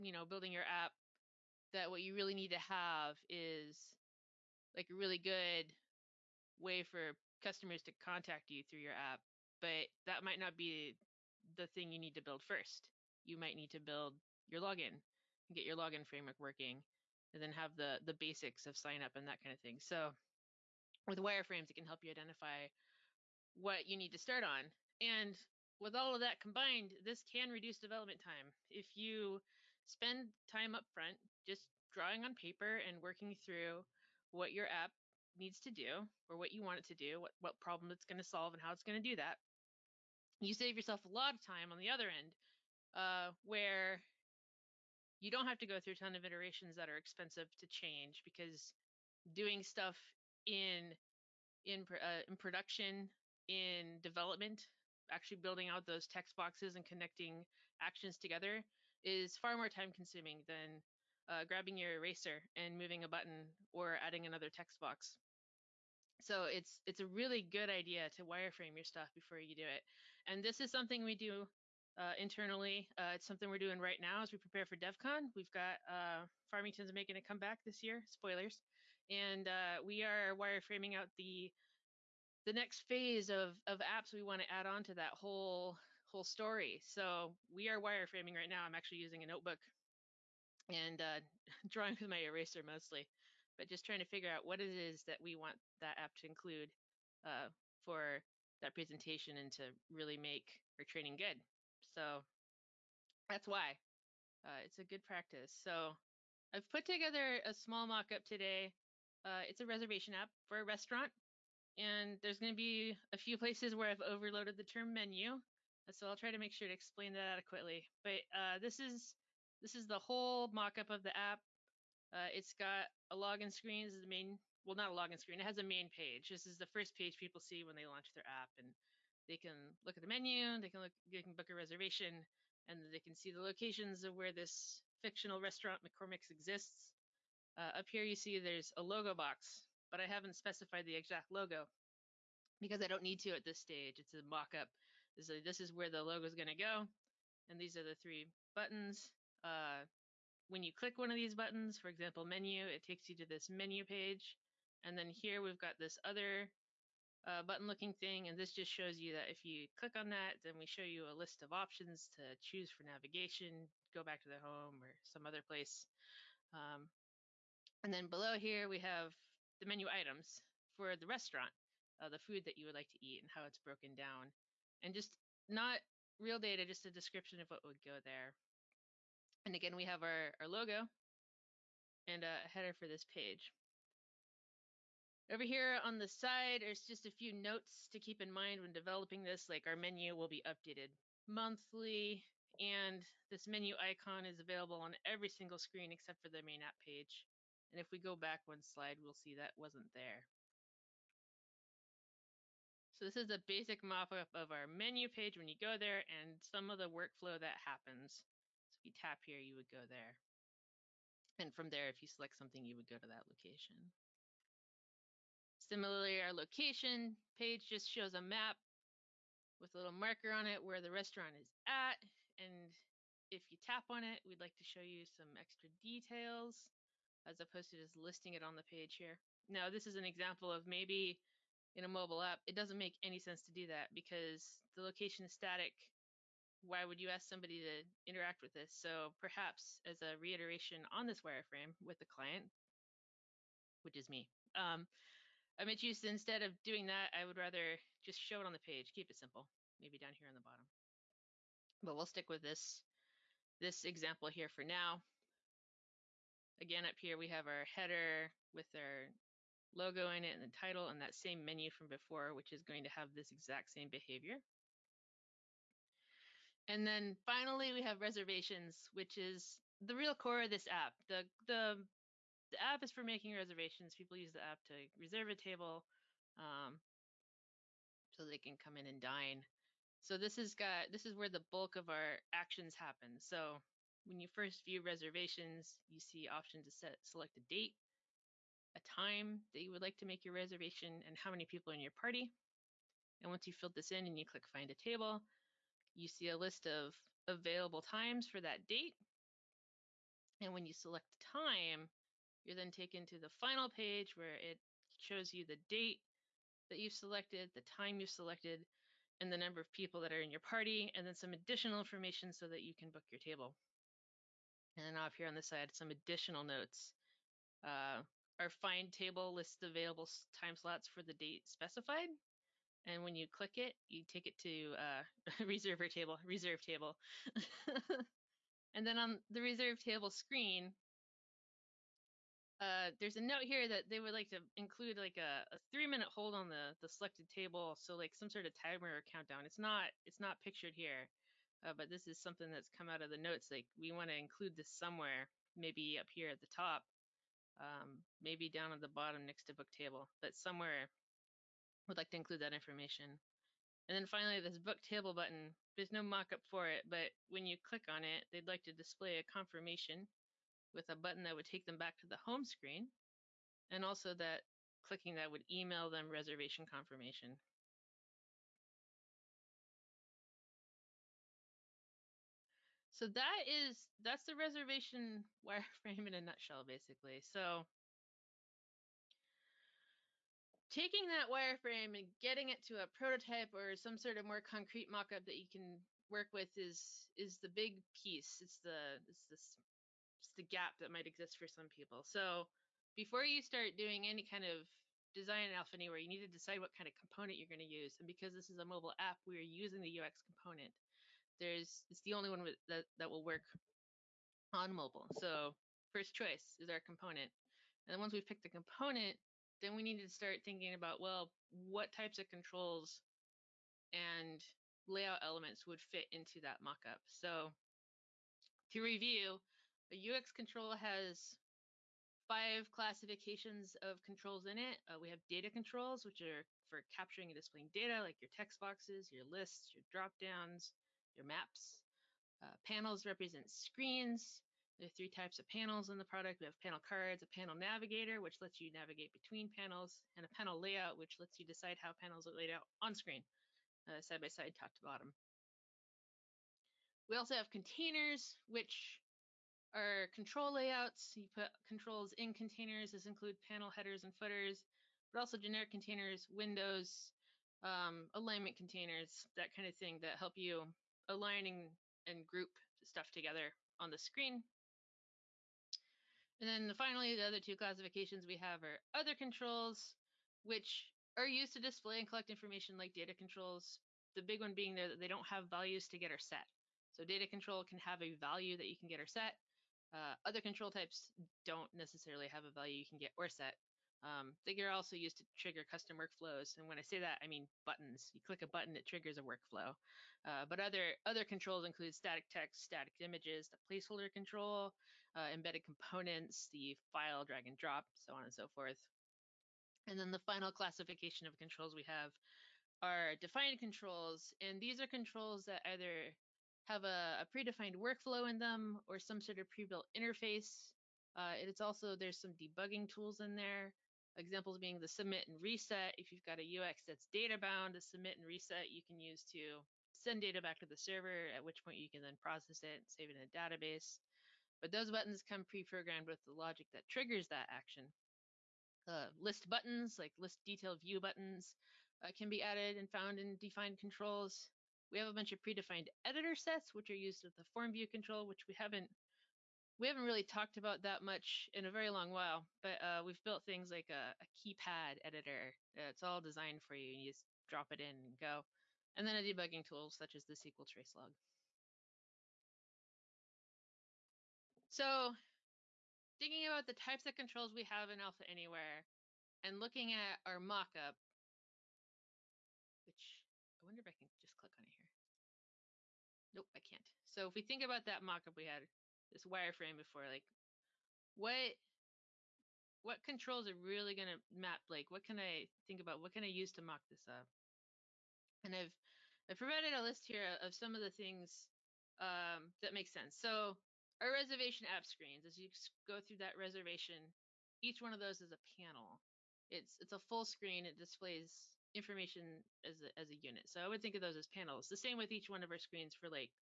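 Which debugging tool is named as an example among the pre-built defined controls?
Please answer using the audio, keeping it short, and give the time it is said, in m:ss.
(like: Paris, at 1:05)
SQL trace log, at 9:10.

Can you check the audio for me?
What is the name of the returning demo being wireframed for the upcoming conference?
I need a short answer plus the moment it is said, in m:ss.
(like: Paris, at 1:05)
Farmington, at 1:16.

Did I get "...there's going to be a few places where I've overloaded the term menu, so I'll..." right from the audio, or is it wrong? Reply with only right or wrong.
right.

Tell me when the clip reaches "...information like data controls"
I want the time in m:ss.
7:52.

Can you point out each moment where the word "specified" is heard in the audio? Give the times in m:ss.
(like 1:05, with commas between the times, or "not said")
2:20, 5:21.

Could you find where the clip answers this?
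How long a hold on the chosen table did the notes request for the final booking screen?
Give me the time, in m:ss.
5:35.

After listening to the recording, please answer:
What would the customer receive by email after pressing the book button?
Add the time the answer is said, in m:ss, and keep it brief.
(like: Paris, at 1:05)
Reservation confirmation, at 6:06.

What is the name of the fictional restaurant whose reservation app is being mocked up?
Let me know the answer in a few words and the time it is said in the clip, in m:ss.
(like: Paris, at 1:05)
McCormick's, at 2:15.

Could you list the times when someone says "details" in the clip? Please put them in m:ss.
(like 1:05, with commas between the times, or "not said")
3:45, 8:50.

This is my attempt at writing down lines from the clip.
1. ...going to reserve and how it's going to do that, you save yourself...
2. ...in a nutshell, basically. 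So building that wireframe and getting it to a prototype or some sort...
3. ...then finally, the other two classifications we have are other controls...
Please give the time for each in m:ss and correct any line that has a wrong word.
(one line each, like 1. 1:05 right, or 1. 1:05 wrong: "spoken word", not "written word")
1. 0:38 wrong: "solve", not "reserve"
2. 6:16 wrong: "taking", not "building"
3. 7:46 right.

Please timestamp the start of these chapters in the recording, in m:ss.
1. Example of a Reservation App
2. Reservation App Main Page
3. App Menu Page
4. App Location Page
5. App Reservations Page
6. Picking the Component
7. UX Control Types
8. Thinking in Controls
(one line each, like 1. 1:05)
1. 1:45
2. 2:02
3. 2:30
4. 3:35
5. 4:25
6. 6:20
7. 6:47
8. 9:15.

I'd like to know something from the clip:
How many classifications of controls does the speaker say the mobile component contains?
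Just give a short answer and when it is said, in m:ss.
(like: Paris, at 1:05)
5, at 7:02.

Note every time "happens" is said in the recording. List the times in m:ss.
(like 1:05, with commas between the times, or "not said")
3:27, 4:42.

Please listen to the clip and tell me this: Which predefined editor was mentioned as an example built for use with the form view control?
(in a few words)
Keypad editor.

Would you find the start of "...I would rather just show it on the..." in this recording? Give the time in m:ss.
4:07.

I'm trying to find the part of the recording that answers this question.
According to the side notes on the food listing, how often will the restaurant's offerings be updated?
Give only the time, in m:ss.
3:11.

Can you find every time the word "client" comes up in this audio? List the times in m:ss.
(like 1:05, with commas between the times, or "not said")
4:02.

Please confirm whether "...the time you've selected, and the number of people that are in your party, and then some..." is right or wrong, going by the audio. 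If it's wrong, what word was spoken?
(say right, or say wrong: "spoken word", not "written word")
right.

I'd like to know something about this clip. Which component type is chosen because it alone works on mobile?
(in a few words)
UX component.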